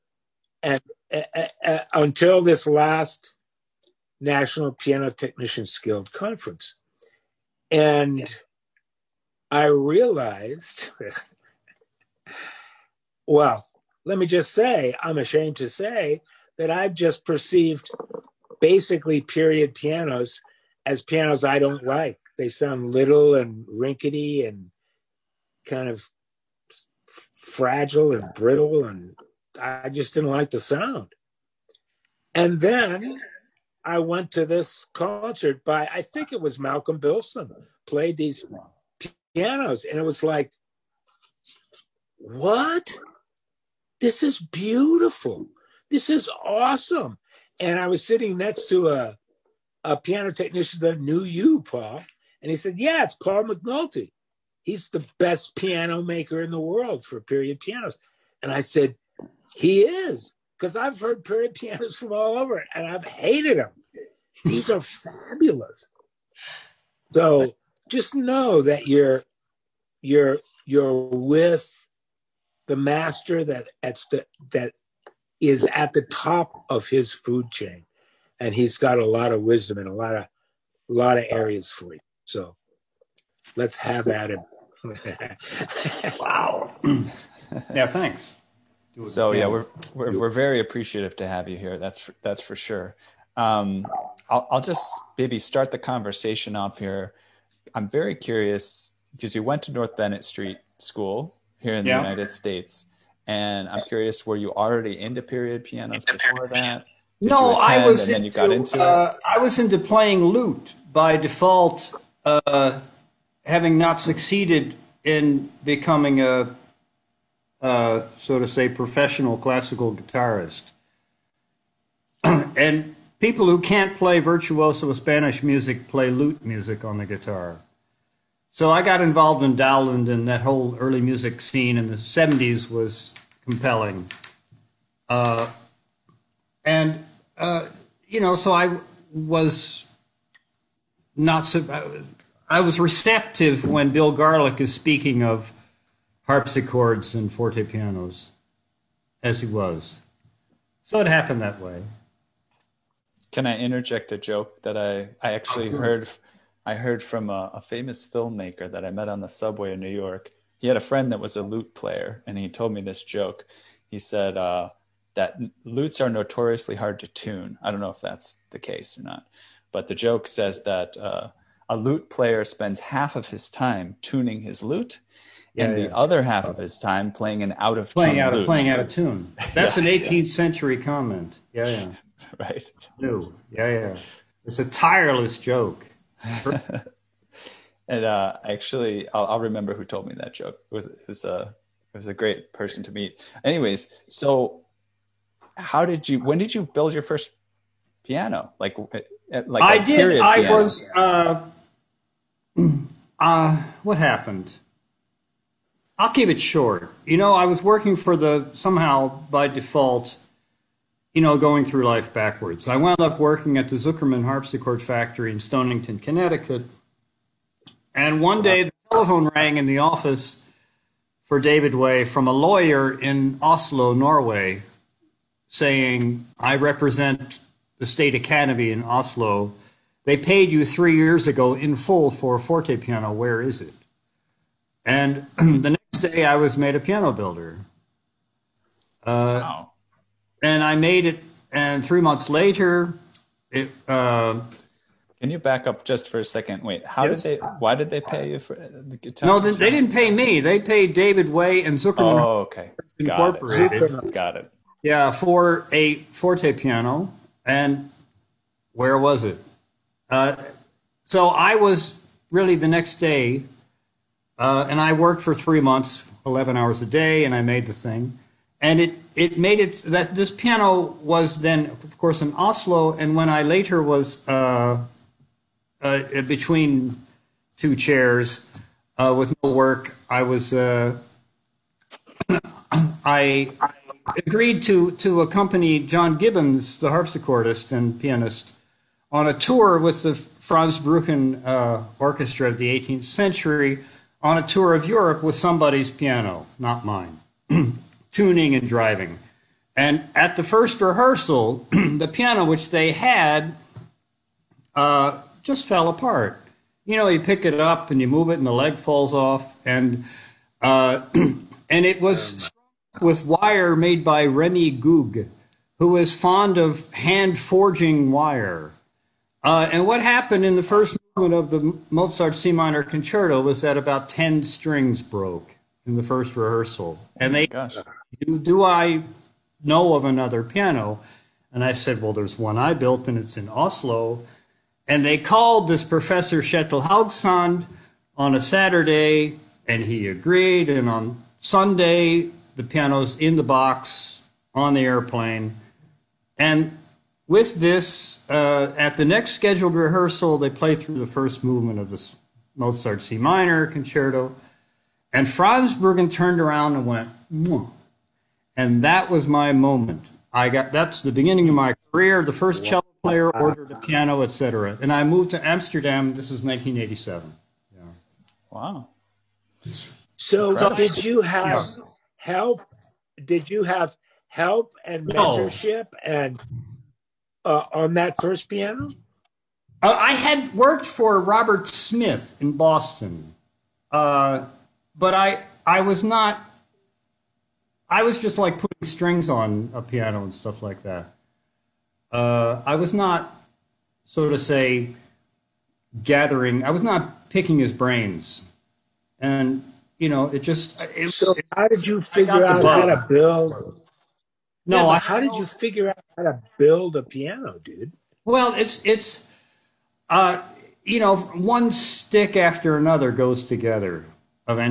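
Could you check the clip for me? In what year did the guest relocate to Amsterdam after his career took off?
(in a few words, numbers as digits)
1987.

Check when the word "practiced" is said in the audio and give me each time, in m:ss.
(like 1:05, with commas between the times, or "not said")
not said.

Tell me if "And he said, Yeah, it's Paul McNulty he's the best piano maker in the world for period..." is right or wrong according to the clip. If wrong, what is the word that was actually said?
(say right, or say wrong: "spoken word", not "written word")
right.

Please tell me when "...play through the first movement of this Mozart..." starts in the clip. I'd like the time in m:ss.
5:50.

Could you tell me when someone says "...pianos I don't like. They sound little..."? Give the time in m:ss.
0:21.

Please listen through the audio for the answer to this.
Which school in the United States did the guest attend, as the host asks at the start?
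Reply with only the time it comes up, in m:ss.
1:39.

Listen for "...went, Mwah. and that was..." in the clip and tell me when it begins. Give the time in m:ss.
5:56.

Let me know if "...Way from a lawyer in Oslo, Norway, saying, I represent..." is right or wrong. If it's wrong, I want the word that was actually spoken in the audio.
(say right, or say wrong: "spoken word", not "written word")
right.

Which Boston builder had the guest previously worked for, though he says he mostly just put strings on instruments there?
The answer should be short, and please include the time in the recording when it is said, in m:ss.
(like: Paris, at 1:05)
Robert Smith, at 6:21.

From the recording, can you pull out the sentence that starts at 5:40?
And on Sunday, the piano's in the box on the airplane.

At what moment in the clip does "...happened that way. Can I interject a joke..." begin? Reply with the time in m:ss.
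2:31.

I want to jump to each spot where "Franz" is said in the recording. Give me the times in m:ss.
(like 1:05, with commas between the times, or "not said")
4:50, 5:55.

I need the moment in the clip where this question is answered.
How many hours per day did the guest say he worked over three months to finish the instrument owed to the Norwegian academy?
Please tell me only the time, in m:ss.
4:26.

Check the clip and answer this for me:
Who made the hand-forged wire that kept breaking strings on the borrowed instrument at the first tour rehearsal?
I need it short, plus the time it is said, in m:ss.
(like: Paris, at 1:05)
Remy Goog, at 5:14.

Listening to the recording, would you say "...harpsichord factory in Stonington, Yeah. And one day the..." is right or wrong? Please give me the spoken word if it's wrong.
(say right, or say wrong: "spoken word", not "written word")
wrong: "Connecticut", not "Yeah".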